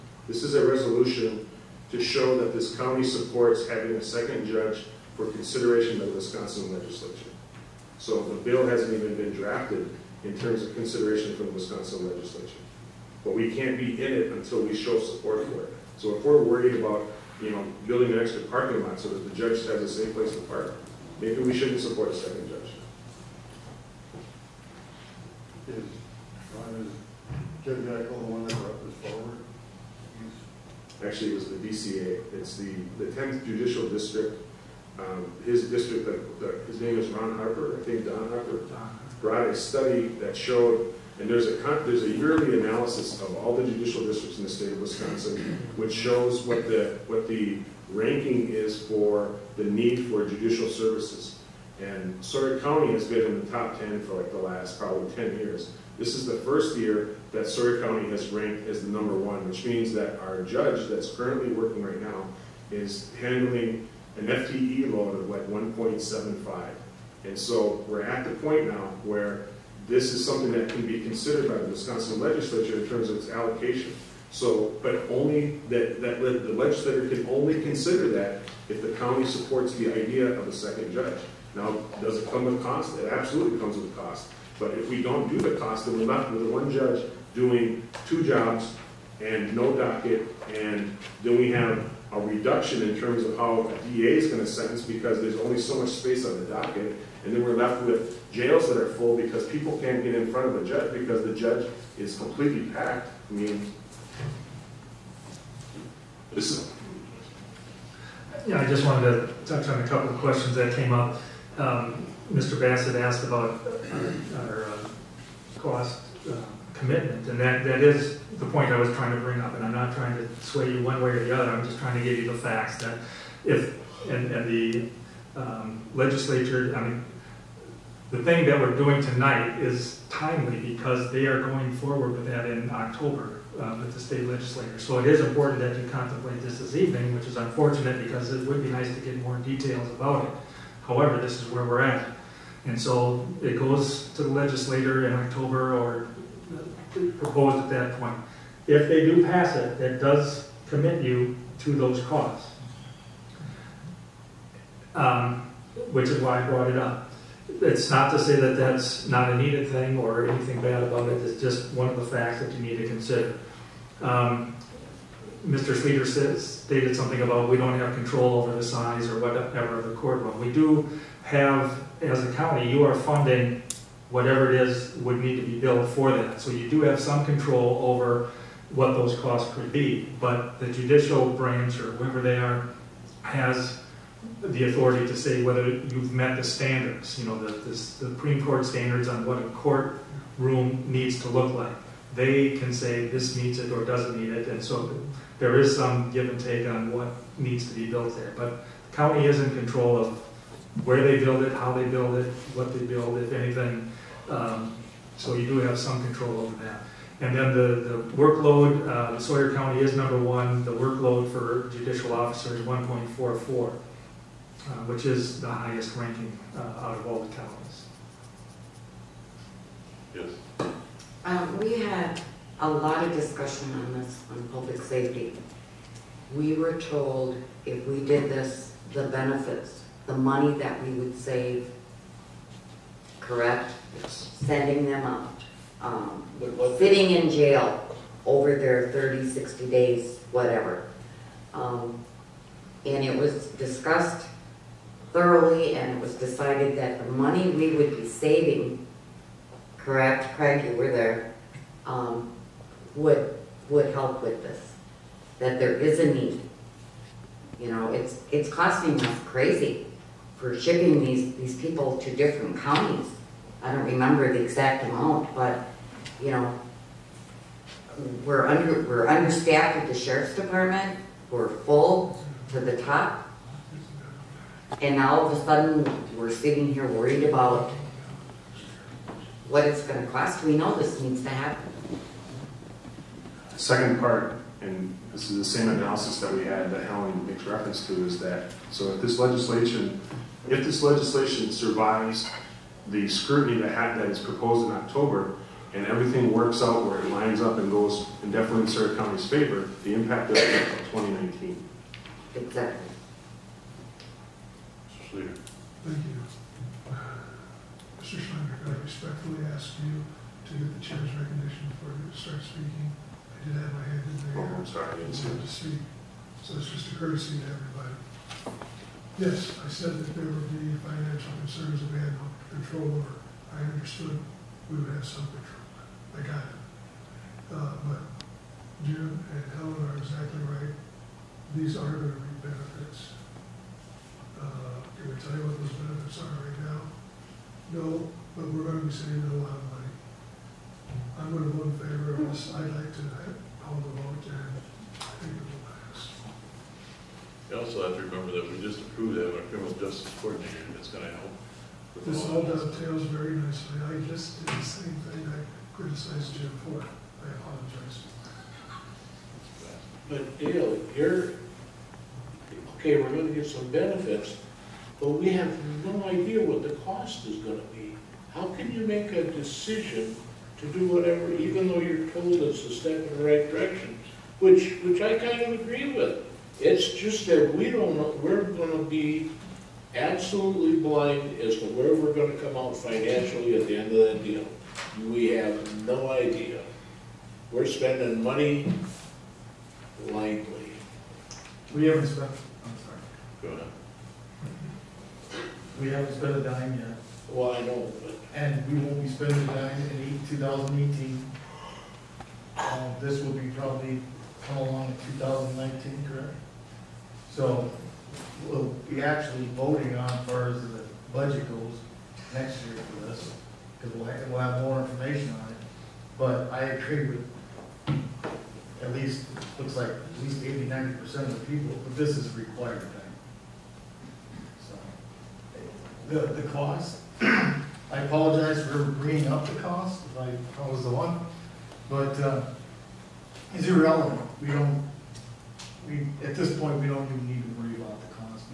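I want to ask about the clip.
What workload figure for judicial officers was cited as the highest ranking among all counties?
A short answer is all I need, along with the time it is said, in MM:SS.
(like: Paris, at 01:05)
1.44, at 03:32.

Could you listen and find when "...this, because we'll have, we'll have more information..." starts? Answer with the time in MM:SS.
06:53.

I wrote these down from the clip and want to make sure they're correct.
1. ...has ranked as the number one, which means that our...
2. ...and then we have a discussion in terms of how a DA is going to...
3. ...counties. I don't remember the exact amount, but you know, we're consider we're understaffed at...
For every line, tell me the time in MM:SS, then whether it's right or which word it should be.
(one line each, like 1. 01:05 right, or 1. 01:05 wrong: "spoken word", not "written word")
1. 00:58 right
2. 01:30 wrong: "reduction", not "discussion"
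3. 04:22 wrong: "under", not "consider".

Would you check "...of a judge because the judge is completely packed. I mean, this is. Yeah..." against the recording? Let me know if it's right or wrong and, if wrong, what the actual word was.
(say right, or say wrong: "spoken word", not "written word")
right.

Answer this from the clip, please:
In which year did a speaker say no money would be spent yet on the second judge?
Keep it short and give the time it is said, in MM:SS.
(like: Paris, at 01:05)
2018, at 06:40.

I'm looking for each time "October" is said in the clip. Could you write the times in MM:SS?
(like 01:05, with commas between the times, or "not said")
02:12, 02:25, 04:54.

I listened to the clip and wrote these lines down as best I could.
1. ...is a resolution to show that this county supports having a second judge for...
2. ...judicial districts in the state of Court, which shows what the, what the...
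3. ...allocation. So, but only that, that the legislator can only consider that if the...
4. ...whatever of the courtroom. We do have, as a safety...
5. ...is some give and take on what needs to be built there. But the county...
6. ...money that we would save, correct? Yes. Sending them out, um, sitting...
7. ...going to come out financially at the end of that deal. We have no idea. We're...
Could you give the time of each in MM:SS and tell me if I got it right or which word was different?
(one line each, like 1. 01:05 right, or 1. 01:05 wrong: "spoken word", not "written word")
1. 00:00 right
2. 00:43 wrong: "Wisconsin", not "Court"
3. 01:13 right
4. 02:49 wrong: "county", not "safety"
5. 03:15 right
6. 03:50 right
7. 06:22 right.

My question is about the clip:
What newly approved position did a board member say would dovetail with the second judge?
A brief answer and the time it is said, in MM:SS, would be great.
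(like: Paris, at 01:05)
criminal justice coordinator, at 05:49.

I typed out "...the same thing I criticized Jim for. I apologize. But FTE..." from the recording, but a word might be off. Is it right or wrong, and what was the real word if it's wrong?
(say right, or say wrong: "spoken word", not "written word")
wrong: "Dale", not "FTE".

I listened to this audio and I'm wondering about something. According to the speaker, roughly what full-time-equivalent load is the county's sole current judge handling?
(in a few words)
1.75.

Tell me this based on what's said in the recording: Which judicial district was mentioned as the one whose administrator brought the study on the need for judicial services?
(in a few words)
10th Judicial District.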